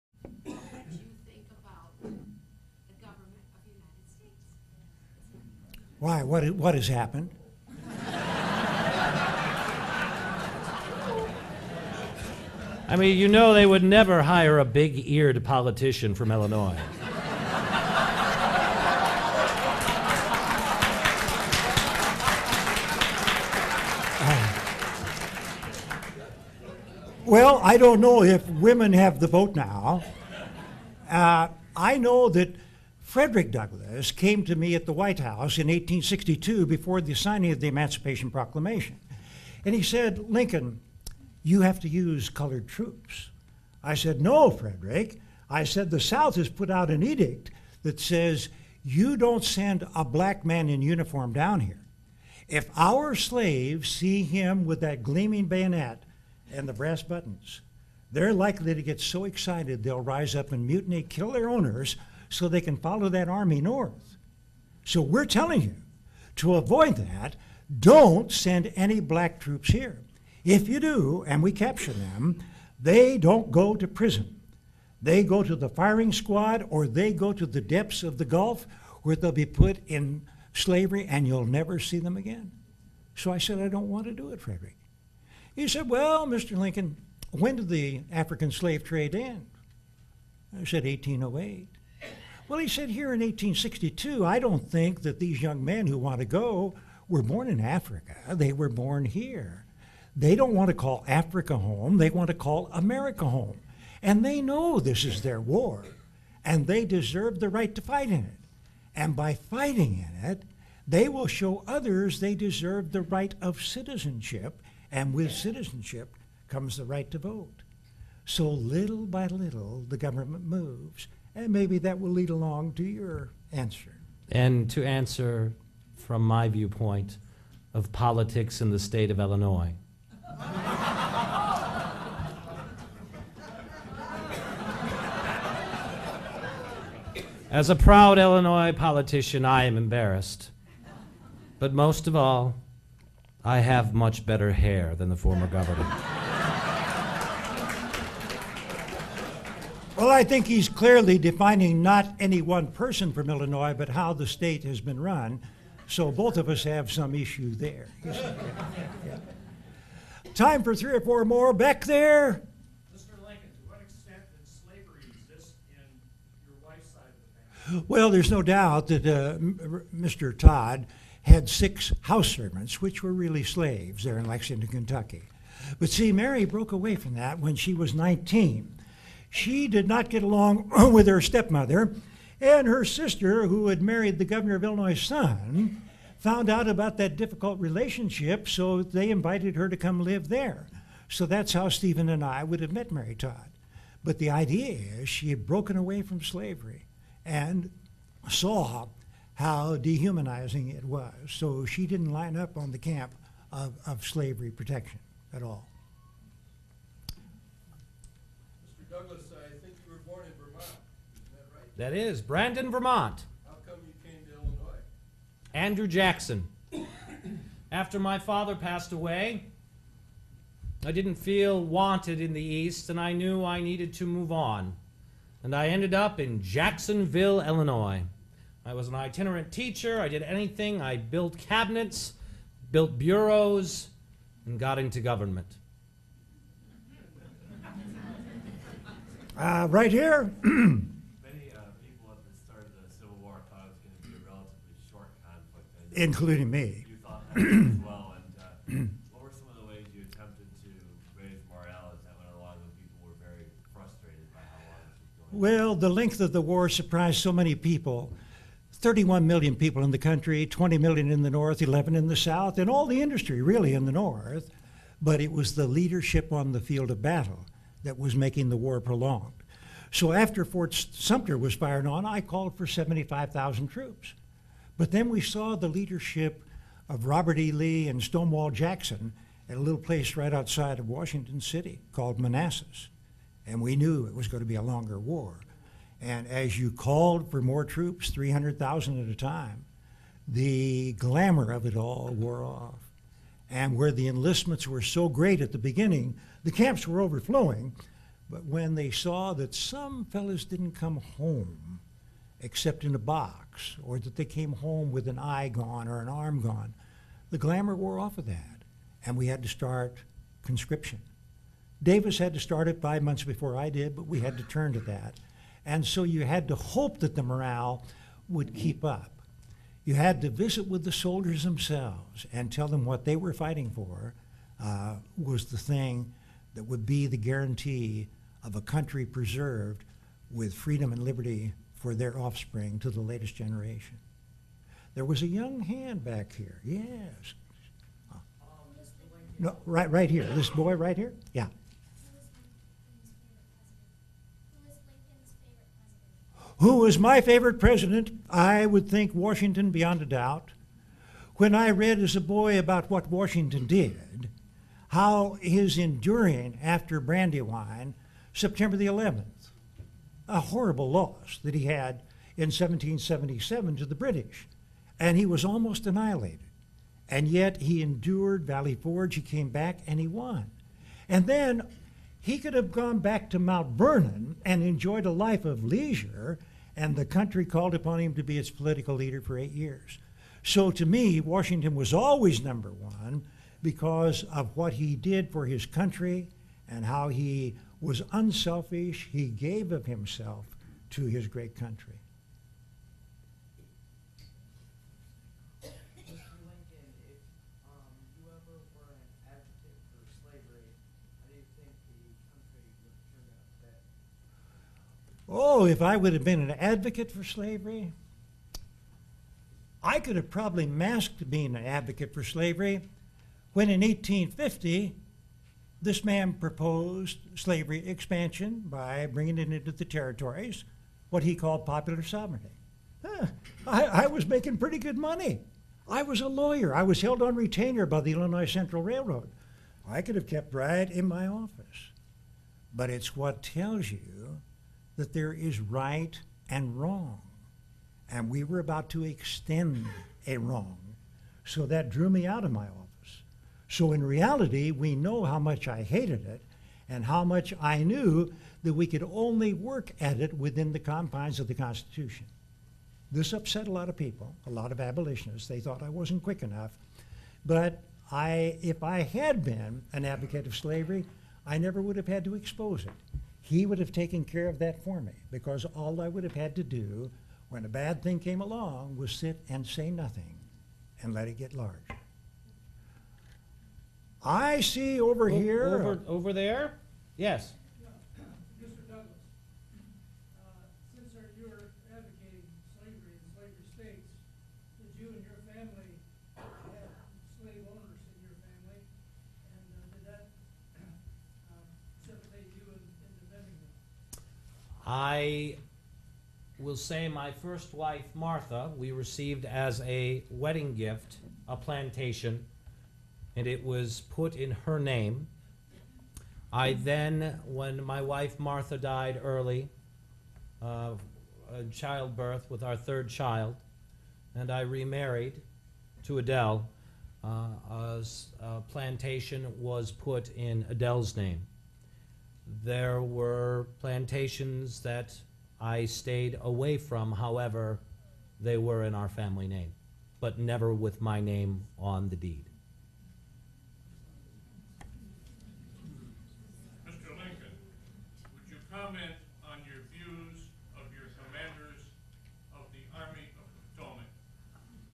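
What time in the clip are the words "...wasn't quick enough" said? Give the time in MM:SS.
07:35.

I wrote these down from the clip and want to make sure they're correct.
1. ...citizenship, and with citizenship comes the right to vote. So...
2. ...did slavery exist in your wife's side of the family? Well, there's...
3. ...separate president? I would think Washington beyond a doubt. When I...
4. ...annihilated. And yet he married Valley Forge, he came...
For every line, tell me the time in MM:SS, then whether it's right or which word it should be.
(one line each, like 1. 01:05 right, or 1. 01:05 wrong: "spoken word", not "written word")
1. 01:53 right
2. 02:44 right
3. 05:47 wrong: "favorite", not "separate"
4. 06:05 wrong: "endured", not "married".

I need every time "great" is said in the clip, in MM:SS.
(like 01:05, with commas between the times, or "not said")
04:55, 06:31.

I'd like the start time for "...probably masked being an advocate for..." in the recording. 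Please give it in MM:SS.
06:50.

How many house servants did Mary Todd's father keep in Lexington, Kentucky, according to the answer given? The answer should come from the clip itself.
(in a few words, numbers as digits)
6.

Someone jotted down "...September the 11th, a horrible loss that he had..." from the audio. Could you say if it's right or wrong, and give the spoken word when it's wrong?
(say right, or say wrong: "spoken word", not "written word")
right.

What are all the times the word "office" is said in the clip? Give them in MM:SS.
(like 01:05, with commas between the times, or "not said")
07:11, 07:22.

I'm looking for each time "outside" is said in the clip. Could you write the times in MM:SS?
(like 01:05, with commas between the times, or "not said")
04:40.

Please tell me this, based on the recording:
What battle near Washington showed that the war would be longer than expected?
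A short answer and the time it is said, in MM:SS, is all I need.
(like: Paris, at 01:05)
Manassas, at 04:42.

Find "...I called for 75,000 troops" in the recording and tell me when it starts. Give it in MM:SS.
04:32.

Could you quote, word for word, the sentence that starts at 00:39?
And he said, Lincoln, you have to use colored troops.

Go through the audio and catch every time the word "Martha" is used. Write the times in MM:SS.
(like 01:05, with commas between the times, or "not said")
08:18, 08:28.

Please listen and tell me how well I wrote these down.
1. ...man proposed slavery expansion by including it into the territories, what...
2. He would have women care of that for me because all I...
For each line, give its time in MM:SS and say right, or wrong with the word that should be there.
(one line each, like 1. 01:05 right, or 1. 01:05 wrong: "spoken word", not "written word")
1. 06:56 wrong: "bringing", not "including"
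2. 07:43 wrong: "taken", not "women".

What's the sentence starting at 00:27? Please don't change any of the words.
Well, I don't know if women have the vote now.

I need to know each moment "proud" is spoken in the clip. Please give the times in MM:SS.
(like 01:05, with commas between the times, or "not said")
02:17.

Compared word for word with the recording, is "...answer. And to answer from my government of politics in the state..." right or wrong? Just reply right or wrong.
wrong.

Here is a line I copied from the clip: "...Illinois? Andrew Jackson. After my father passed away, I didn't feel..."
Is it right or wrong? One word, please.
right.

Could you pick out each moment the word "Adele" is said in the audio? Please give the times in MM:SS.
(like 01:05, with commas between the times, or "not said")
08:36, 08:40.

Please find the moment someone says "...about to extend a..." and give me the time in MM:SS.
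07:18.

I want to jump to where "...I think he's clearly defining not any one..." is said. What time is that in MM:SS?
02:30.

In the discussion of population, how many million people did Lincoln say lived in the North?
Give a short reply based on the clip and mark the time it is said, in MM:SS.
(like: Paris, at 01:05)
20 million, at 04:20.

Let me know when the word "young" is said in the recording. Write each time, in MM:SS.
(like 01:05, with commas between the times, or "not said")
01:35, 05:35.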